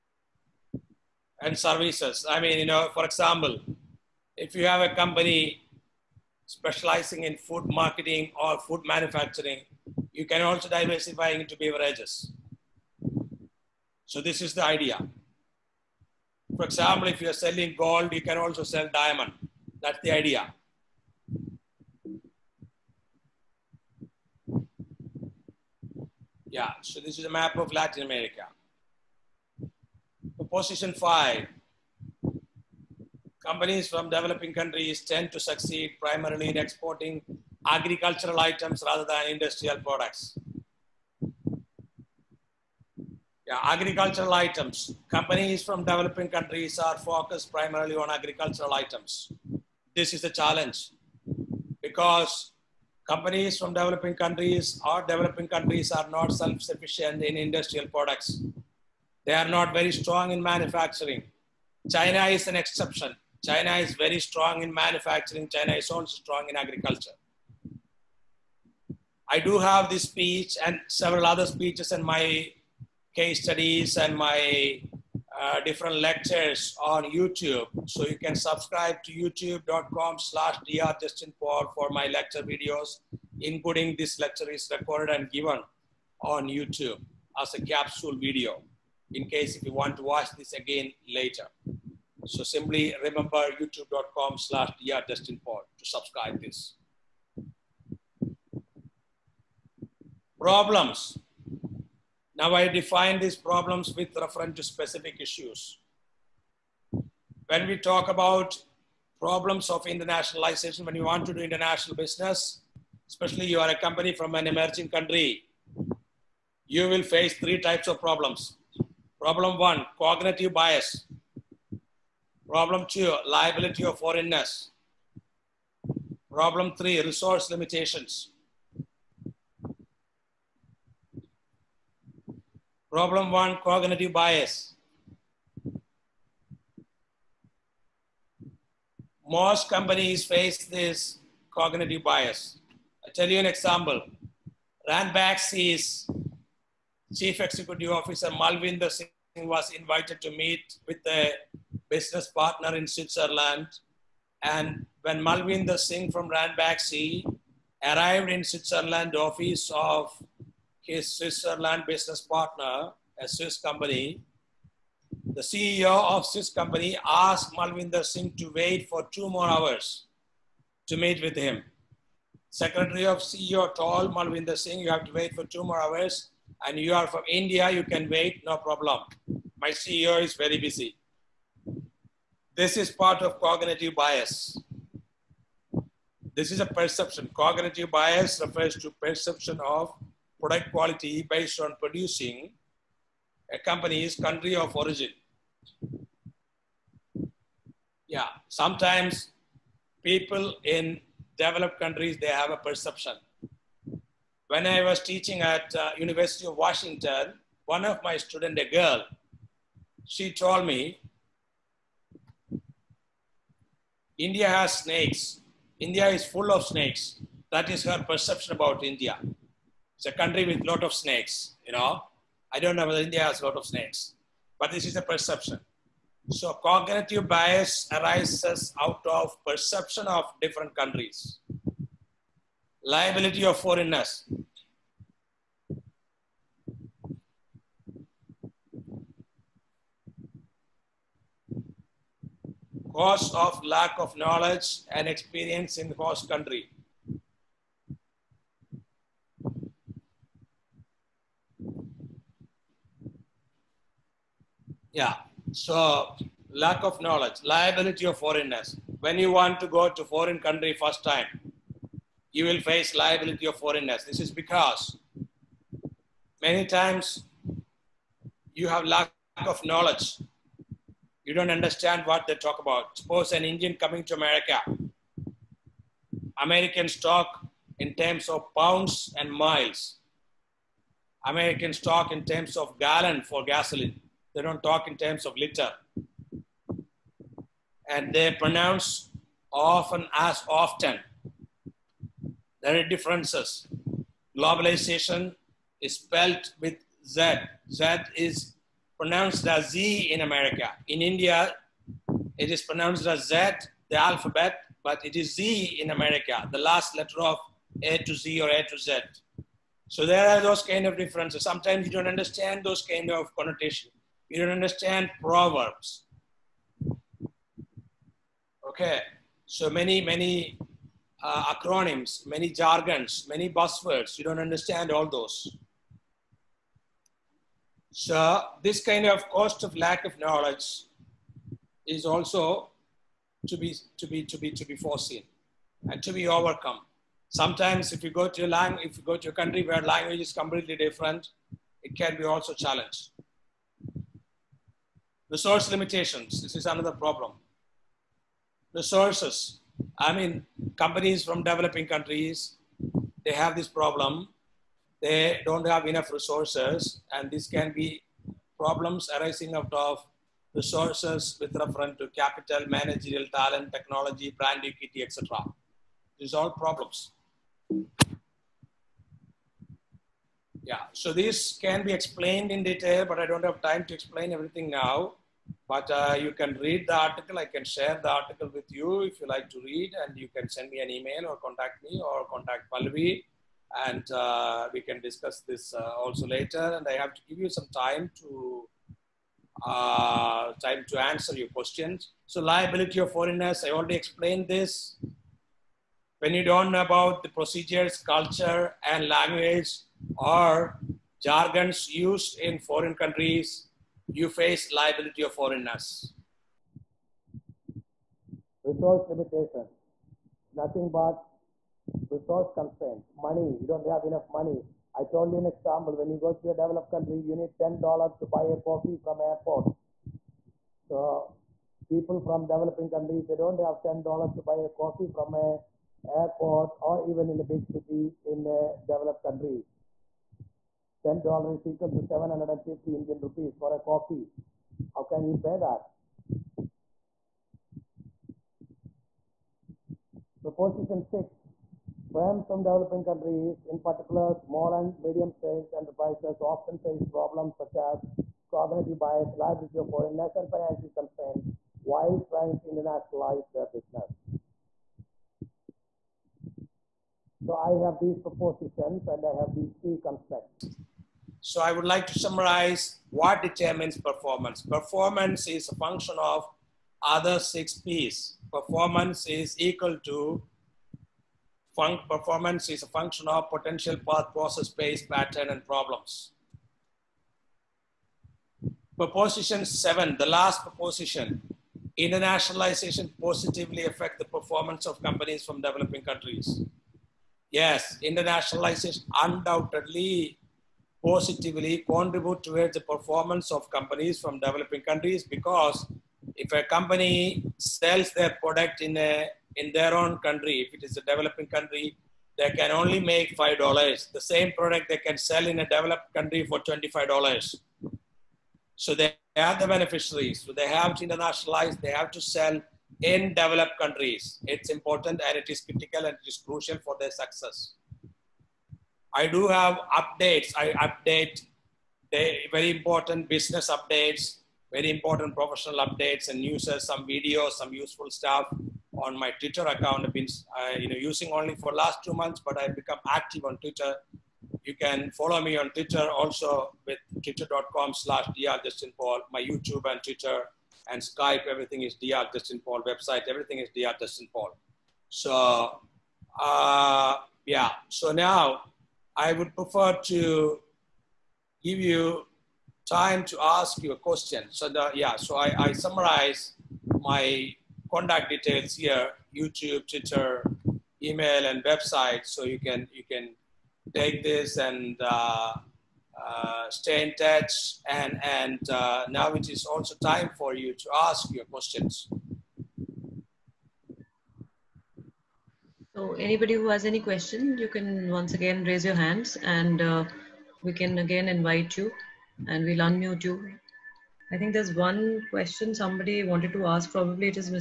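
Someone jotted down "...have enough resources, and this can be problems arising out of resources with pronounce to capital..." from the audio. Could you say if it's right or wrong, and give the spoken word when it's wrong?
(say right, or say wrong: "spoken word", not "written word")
wrong: "reference", not "pronounce".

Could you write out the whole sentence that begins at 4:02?
Cause of lack of knowledge and experience in the host country.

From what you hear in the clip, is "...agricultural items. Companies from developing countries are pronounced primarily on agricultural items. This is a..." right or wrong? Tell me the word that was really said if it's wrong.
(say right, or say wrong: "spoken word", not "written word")
wrong: "focused", not "pronounced".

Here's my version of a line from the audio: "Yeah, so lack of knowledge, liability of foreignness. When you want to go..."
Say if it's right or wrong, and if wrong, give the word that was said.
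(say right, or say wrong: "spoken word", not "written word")
right.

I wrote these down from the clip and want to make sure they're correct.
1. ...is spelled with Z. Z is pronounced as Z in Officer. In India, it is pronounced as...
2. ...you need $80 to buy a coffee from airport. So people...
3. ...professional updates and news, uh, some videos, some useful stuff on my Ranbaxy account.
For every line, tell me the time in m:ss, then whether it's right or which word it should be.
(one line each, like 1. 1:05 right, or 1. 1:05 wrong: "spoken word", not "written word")
1. 4:55 wrong: "America", not "Officer"
2. 6:57 wrong: "10", not "80"
3. 8:45 wrong: "Twitter", not "Ranbaxy".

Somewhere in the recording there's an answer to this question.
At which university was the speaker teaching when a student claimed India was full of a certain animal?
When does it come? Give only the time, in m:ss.
3:25.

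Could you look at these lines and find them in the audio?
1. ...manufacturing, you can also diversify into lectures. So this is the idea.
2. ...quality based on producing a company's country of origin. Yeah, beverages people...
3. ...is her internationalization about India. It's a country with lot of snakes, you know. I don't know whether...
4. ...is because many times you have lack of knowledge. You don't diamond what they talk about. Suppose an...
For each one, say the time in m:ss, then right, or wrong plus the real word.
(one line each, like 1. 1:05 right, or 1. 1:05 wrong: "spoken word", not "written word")
1. 0:08 wrong: "beverages", not "lectures"
2. 3:10 wrong: "sometimes", not "beverages"
3. 3:37 wrong: "perception", not "internationalization"
4. 4:24 wrong: "understand", not "diamond".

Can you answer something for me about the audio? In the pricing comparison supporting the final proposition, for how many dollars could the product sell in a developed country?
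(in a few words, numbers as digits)
$25.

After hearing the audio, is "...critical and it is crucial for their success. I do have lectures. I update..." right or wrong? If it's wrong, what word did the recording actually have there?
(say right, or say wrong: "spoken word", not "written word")
wrong: "updates", not "lectures".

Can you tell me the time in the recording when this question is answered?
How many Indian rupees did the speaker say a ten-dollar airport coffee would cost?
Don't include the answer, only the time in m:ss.
7:12.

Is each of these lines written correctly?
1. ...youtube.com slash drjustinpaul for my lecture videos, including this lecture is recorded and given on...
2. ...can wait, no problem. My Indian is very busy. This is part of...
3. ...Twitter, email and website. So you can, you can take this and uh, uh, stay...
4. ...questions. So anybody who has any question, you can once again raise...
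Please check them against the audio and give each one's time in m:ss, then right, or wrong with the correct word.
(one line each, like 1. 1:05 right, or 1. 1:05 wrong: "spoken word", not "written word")
1. 1:19 right
2. 2:57 wrong: "CEO", not "Indian"
3. 9:19 right
4. 9:31 right.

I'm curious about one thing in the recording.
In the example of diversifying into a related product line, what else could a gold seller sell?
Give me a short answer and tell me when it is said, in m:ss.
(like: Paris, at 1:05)
Diamond, at 0:18.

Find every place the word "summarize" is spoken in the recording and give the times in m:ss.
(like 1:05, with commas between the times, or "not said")
7:42, 9:15.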